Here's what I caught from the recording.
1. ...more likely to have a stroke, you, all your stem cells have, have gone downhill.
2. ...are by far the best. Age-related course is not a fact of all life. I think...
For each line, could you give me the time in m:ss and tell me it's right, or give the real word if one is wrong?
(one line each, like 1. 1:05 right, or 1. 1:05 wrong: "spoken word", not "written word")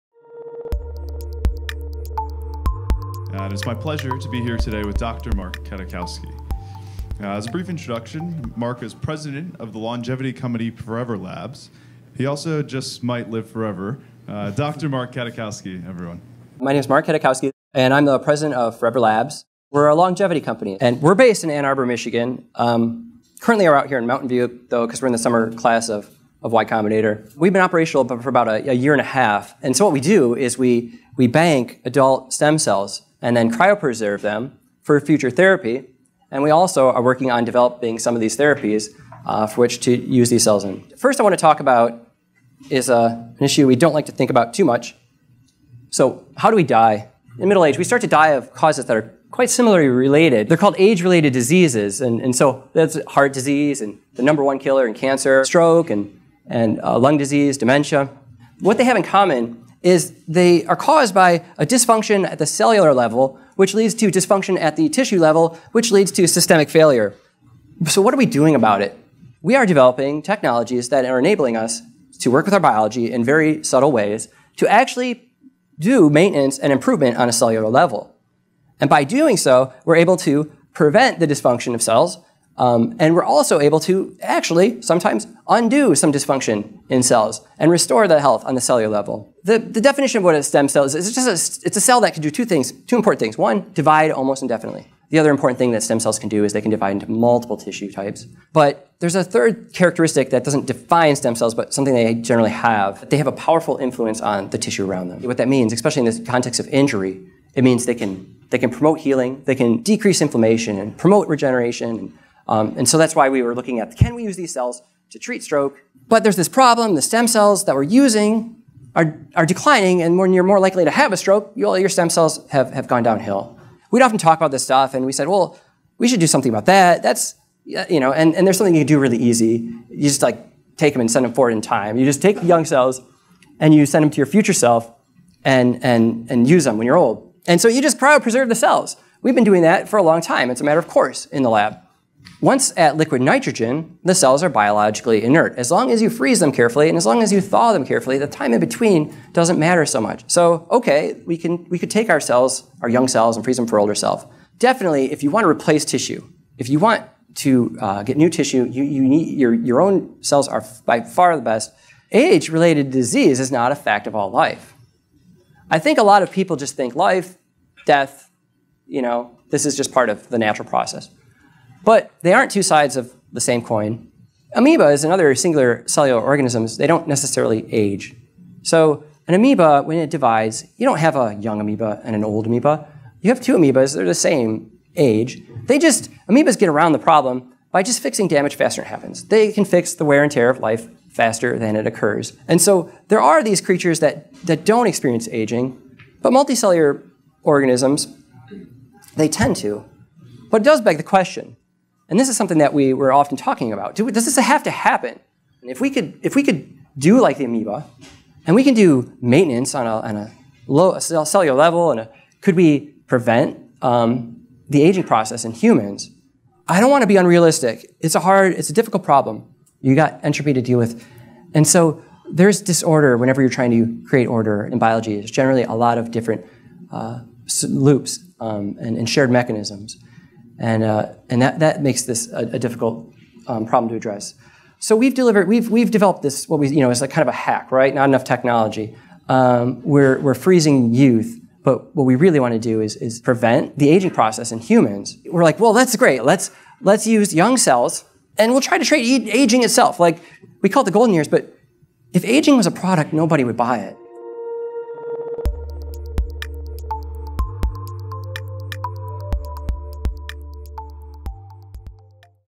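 1. 2:00 right
2. 2:40 wrong: "disease", not "course".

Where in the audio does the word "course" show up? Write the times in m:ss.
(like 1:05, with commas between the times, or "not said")
2:20.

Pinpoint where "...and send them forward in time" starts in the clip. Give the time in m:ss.
2:10.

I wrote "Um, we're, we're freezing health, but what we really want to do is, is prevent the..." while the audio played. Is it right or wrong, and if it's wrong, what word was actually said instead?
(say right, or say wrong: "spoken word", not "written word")
wrong: "youth", not "health".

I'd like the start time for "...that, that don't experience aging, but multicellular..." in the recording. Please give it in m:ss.
3:14.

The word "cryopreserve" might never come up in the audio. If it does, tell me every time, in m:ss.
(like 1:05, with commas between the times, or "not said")
0:33, 2:17.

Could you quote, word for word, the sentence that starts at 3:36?
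I don't want to be unrealistic.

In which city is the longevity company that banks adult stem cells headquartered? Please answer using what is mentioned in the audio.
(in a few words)
Ann Arbor, Michigan.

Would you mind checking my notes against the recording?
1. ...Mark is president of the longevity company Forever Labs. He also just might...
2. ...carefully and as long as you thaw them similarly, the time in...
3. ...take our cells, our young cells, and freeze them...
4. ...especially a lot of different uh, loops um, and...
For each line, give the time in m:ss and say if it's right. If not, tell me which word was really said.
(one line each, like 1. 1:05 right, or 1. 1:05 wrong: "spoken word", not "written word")
1. 0:08 right
2. 2:26 wrong: "carefully", not "similarly"
3. 2:31 right
4. 3:45 wrong: "generally", not "especially".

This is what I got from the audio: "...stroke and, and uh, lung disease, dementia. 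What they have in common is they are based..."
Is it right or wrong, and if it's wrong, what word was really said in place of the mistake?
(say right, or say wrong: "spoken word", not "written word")
wrong: "caused", not "based".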